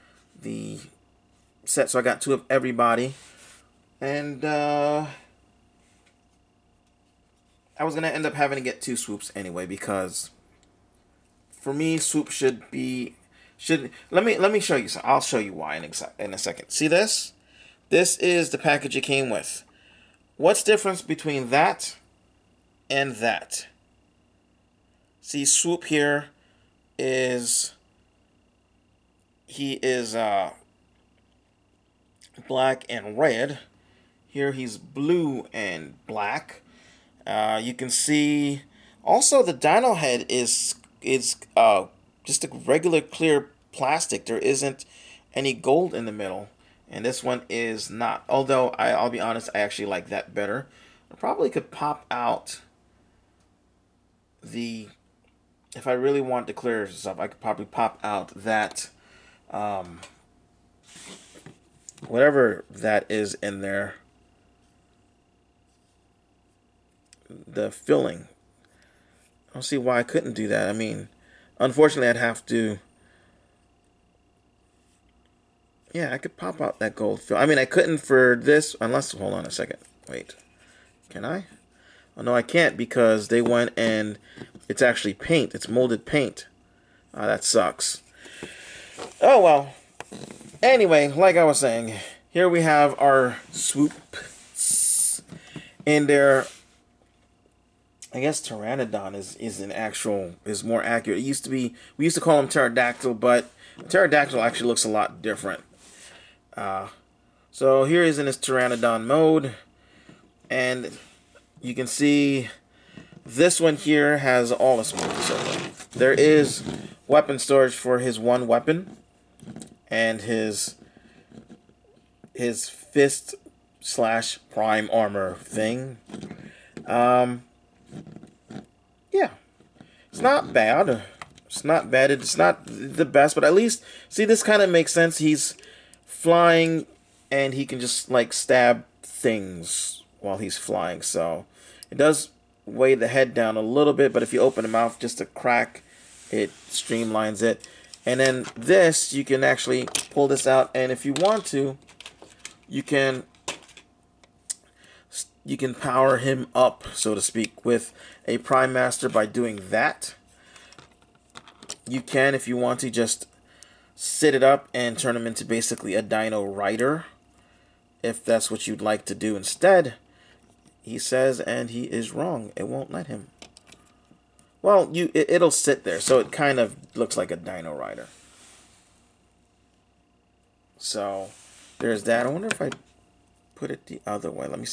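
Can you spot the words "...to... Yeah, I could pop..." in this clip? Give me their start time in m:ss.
1:12.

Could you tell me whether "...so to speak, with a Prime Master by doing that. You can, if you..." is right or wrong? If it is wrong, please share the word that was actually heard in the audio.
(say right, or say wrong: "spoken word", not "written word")
right.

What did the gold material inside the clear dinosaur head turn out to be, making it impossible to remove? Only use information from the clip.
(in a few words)
Molded paint.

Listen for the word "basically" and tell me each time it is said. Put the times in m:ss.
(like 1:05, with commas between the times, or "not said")
2:45.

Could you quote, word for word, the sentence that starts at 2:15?
He's flying, and he can just like stab things while he's flying.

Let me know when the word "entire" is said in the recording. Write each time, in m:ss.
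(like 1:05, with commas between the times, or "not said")
not said.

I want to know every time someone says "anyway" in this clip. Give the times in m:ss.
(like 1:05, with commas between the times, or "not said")
0:09, 1:30.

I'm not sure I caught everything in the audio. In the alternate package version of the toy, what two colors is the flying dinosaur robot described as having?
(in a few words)
Blue and black.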